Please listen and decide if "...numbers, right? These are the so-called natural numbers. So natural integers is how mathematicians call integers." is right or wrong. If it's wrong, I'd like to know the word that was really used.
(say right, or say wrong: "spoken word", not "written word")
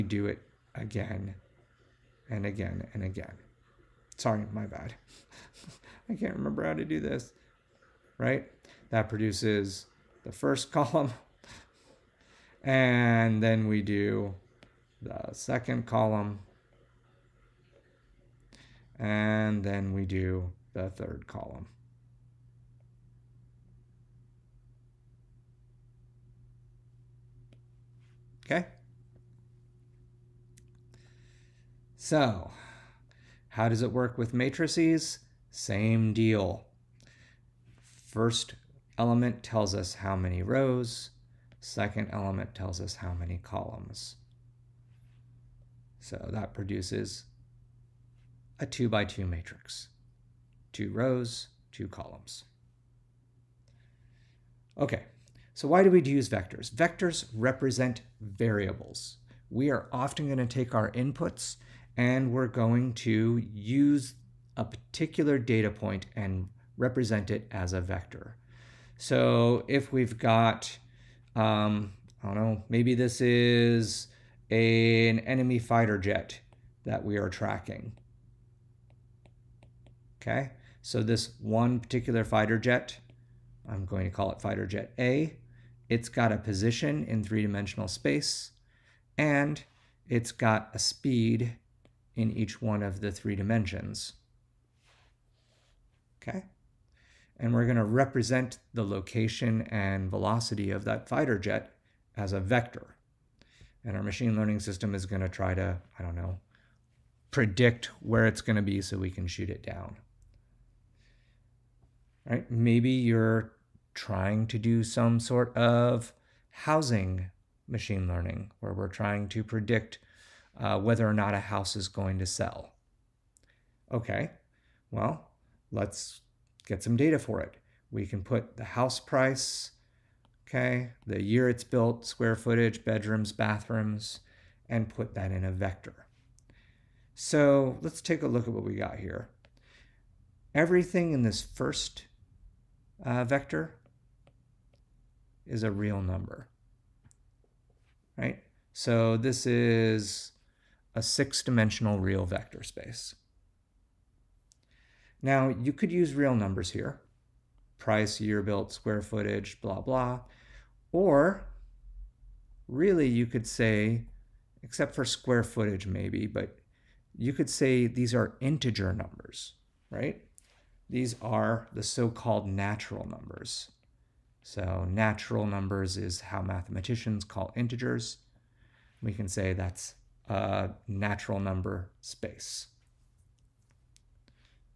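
wrong: "numbers", not "integers".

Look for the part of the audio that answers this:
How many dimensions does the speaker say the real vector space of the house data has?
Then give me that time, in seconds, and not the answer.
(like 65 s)
151 s.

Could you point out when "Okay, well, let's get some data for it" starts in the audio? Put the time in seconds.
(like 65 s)
123 s.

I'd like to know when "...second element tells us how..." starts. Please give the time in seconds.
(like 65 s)
41 s.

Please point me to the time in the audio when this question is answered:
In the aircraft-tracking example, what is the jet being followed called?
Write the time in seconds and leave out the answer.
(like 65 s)
84 s.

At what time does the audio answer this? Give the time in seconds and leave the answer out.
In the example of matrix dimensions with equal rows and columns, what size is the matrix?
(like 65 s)
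48 s.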